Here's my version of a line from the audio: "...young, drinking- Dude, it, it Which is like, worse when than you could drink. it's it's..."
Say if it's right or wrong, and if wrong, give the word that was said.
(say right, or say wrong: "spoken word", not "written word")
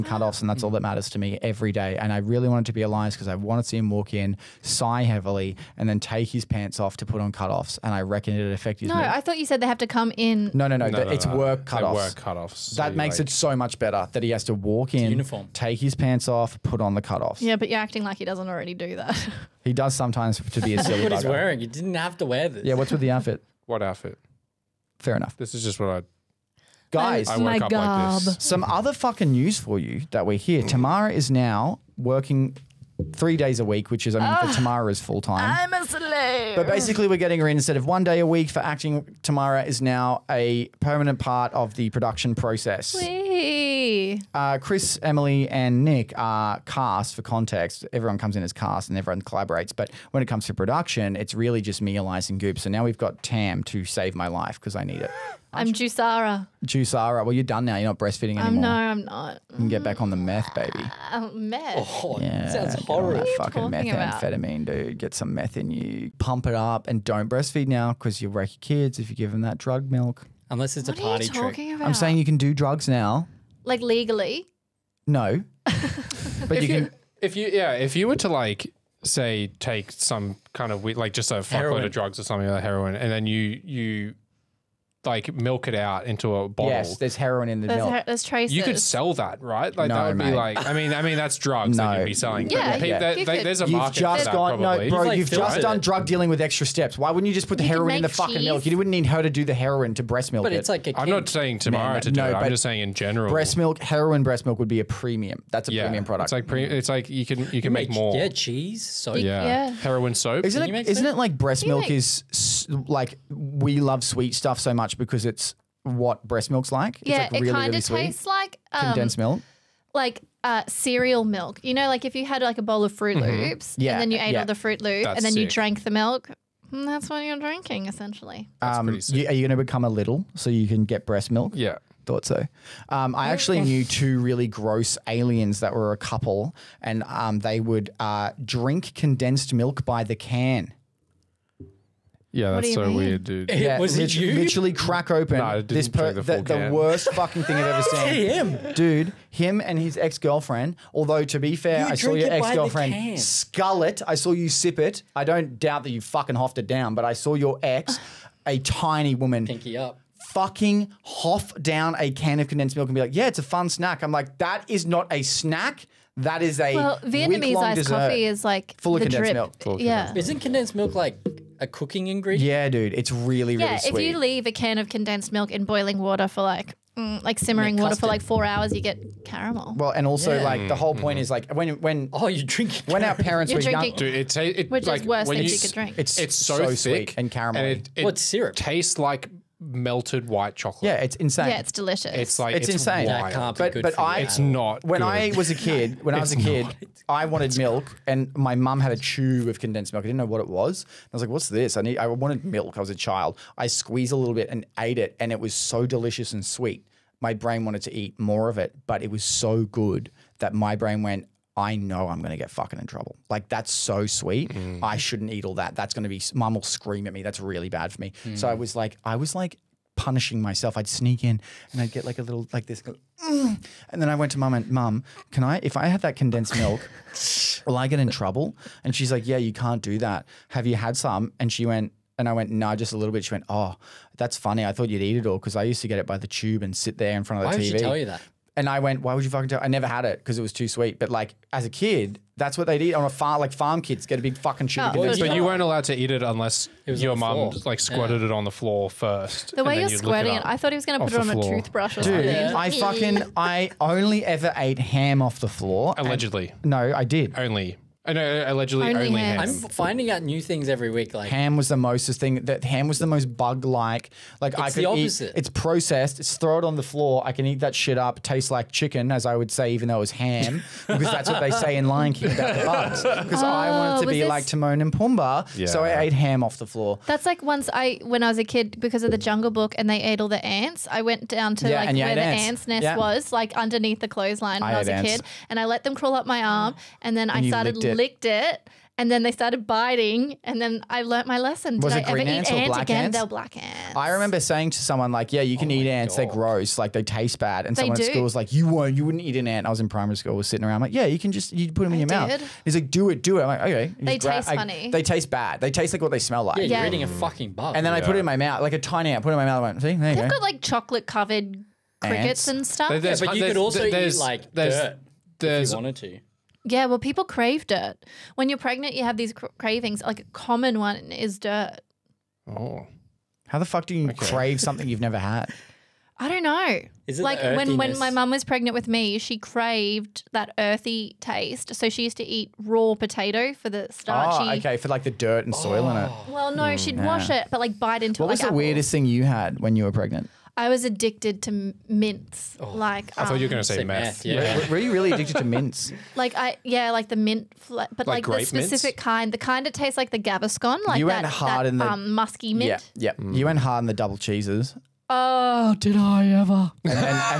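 right.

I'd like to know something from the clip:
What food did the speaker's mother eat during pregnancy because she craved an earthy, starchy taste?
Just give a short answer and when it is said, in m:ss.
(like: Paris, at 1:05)
Raw potato, at 5:32.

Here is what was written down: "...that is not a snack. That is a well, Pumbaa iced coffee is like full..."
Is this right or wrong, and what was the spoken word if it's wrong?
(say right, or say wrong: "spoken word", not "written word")
wrong: "Vietnamese", not "Pumbaa".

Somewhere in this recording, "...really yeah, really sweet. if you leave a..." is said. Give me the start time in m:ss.
2:53.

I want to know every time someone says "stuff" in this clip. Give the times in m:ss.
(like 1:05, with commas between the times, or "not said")
1:54, 5:12.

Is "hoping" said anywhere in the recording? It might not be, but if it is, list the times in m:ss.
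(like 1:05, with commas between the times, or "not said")
not said.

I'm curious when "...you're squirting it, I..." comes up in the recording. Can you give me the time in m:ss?
4:09.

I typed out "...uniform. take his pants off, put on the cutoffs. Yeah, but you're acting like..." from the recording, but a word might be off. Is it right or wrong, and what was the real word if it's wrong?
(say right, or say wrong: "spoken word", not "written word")
right.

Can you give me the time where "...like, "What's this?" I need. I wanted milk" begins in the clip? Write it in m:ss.
3:21.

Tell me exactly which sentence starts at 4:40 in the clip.
I went down to yeah, like where the ants, ants nest yeah.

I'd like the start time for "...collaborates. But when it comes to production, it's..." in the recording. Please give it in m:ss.
0:49.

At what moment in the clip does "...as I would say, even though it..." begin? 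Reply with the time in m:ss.
4:29.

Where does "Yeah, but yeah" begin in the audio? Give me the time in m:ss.
1:32.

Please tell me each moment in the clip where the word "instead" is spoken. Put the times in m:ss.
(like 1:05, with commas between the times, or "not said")
0:37.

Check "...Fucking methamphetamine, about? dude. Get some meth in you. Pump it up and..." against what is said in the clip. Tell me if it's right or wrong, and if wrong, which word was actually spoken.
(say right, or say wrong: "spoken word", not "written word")
right.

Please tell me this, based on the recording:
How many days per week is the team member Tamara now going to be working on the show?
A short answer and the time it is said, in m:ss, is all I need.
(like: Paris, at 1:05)
3, at 0:33.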